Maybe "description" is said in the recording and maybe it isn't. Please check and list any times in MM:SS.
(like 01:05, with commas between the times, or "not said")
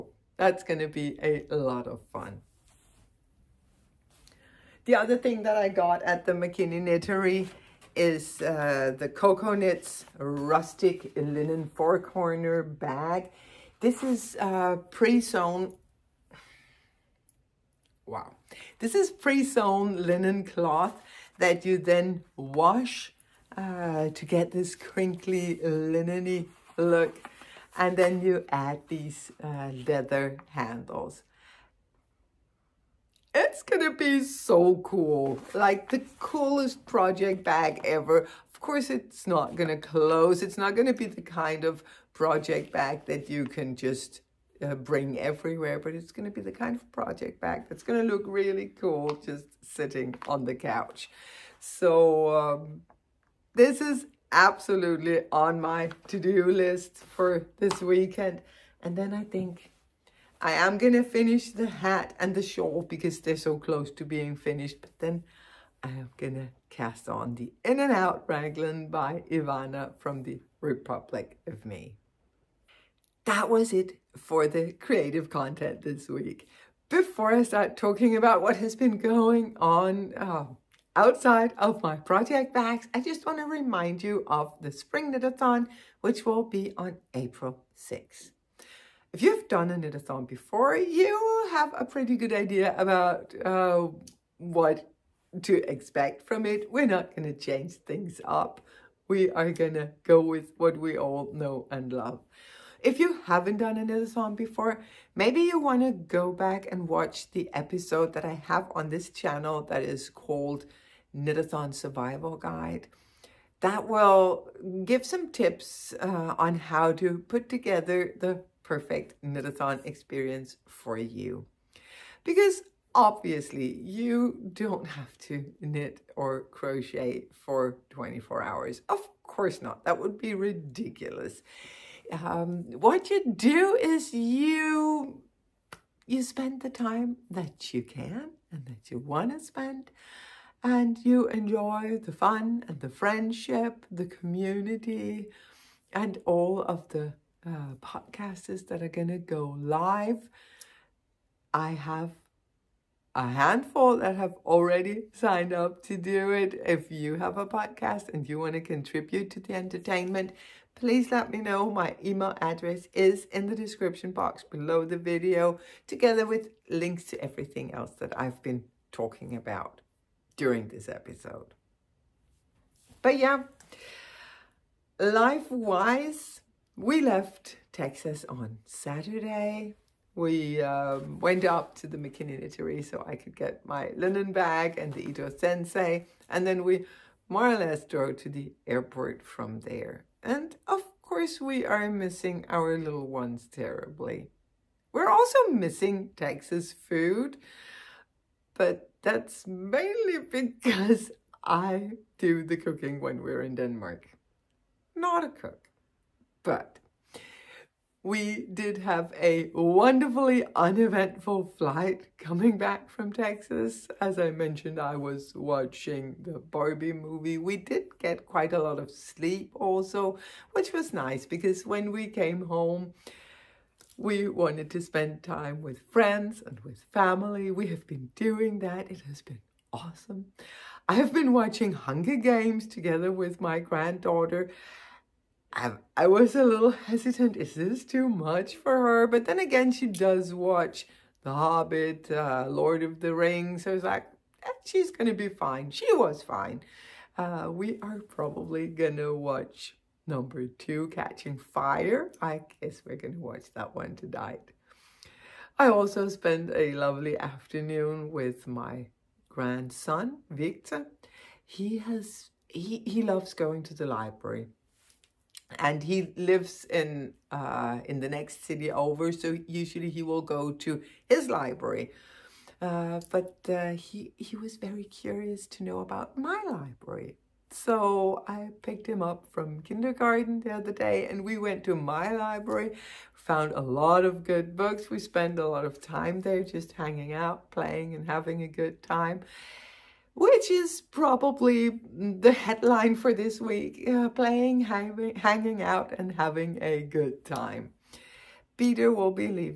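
02:43.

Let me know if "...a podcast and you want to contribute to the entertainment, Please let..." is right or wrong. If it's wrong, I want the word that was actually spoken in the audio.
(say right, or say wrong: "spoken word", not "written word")
right.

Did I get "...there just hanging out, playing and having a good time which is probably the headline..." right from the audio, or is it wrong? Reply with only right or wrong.
right.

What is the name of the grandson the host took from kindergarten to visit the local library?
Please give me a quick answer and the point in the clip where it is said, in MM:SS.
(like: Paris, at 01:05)
Victor, at 04:20.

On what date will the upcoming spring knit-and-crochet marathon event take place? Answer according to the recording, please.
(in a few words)
April 6th.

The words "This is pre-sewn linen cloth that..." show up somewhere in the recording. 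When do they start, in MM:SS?
00:18.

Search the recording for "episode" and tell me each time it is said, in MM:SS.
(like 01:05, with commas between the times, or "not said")
01:47, 02:50.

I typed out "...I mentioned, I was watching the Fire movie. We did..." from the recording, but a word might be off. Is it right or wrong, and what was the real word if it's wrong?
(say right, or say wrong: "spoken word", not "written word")
wrong: "Barbie", not "Fire".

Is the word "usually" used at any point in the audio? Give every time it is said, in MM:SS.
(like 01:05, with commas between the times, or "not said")
04:29.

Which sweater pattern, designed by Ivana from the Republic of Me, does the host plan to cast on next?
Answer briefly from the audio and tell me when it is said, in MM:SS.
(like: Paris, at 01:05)
In and Out Raglan, at 01:07.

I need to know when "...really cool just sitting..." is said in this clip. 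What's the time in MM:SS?
00:48.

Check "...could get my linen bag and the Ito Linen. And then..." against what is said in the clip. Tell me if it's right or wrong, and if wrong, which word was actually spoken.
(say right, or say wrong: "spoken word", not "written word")
wrong: "Sensai", not "Linen".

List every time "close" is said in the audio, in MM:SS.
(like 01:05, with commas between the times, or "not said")
00:39, 01:03.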